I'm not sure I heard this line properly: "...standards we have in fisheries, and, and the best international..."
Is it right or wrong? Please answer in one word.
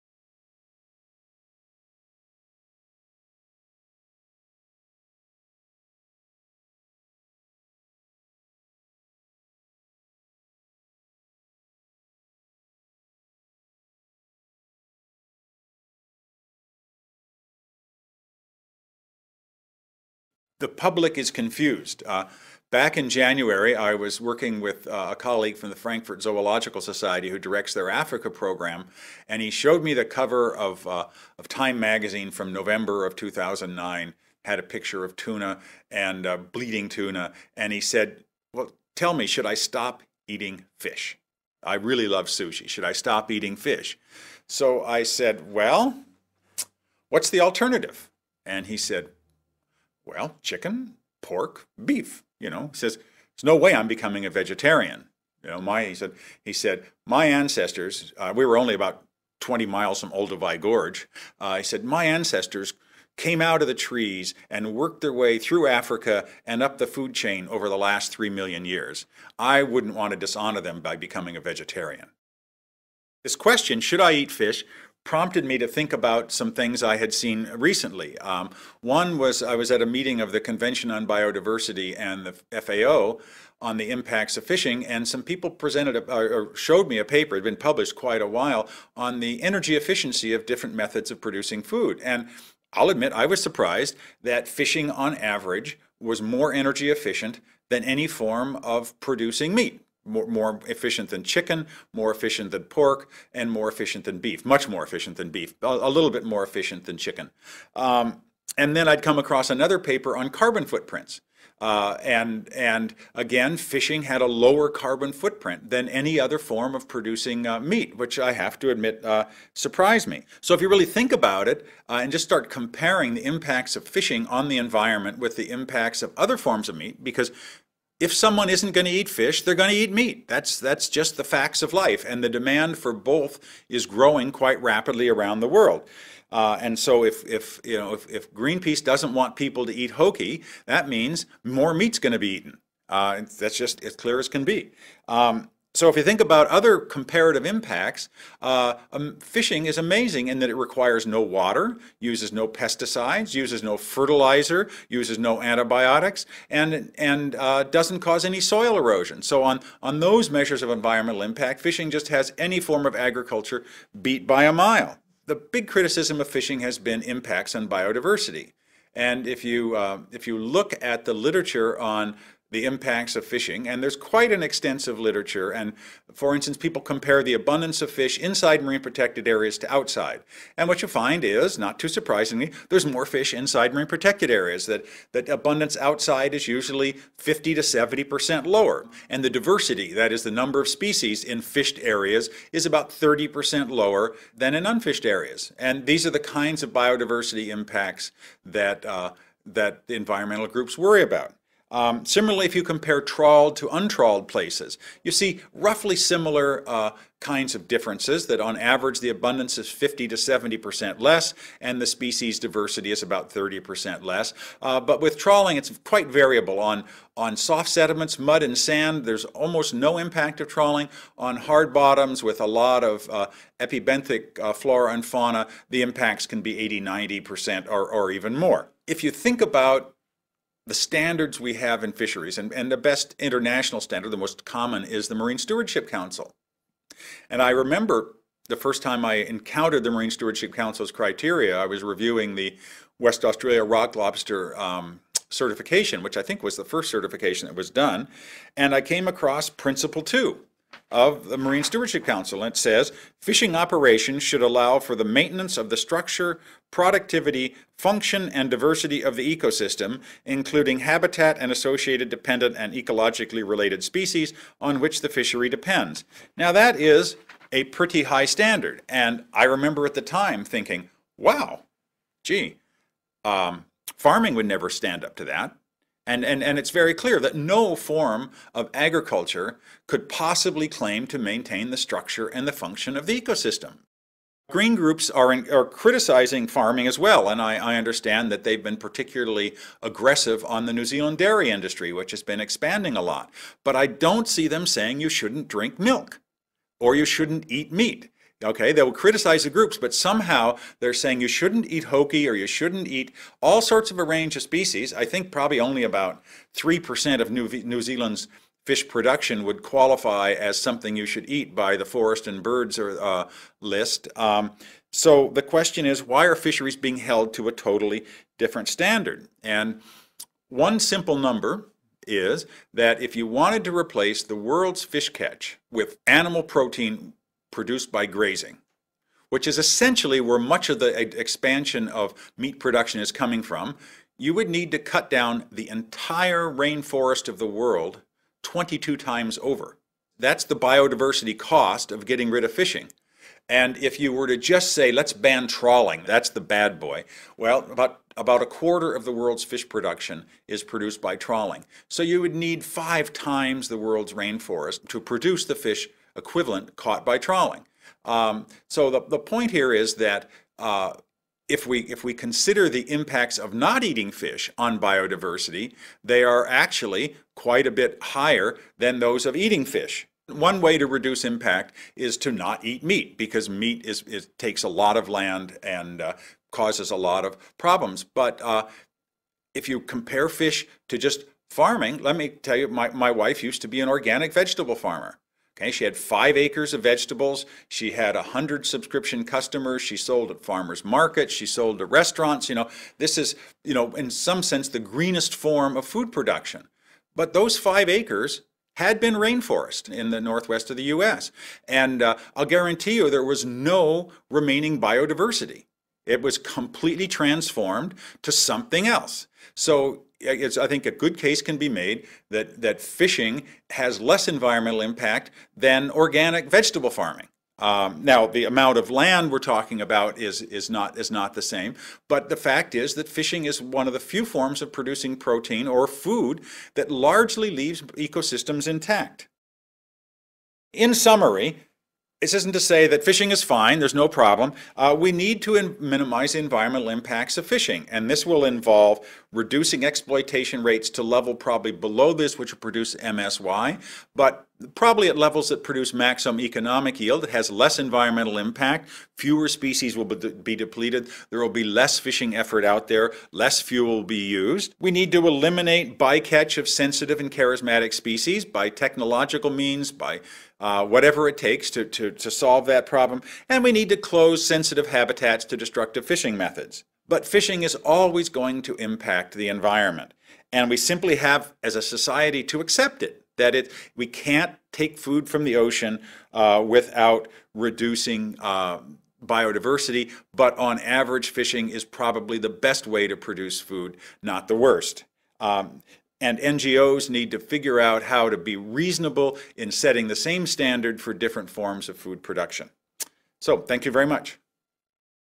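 right.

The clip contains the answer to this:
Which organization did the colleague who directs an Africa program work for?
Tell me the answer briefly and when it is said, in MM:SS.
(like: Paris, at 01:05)
Frankfurt Zoological Society, at 00:25.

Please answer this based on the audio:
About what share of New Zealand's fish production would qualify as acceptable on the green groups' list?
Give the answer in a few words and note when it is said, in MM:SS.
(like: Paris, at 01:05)
3%, at 05:06.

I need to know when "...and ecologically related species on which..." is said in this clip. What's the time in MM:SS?
04:22.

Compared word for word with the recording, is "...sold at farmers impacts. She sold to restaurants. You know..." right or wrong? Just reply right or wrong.
wrong.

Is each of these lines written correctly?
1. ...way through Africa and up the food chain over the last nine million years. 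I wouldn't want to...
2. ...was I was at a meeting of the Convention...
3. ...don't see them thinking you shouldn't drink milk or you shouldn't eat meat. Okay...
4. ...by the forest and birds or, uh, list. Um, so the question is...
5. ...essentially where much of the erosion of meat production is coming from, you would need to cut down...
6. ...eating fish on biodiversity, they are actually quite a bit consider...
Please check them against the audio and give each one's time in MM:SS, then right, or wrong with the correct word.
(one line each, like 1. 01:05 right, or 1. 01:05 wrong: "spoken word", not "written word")
1. 01:05 wrong: "three", not "nine"
2. 01:19 right
3. 04:53 wrong: "saying", not "thinking"
4. 05:11 right
5. 05:29 wrong: "expansion", not "erosion"
6. 06:03 wrong: "higher", not "consider".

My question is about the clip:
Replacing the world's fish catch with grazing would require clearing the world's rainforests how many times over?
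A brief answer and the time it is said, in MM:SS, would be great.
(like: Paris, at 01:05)
22, at 05:38.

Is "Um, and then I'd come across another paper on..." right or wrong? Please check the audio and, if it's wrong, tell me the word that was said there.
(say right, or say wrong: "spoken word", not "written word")
right.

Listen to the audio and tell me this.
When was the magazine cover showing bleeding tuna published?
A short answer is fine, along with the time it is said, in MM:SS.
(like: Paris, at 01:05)
November 2009, at 00:32.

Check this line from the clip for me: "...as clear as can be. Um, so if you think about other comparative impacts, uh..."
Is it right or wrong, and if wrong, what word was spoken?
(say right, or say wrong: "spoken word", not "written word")
right.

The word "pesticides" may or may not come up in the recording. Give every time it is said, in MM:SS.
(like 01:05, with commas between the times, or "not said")
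02:32.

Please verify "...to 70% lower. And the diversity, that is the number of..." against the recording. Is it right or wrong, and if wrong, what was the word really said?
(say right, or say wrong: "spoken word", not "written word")
right.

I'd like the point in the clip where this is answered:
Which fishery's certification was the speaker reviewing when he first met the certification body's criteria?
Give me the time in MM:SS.
04:02.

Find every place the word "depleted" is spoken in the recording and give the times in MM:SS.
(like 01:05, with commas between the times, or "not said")
07:30.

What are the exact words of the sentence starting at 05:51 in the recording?
So you would need five times the world's rainforest to produce the fish equivalent caught by trawling.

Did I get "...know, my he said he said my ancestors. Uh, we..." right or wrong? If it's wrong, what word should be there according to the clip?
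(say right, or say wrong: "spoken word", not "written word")
right.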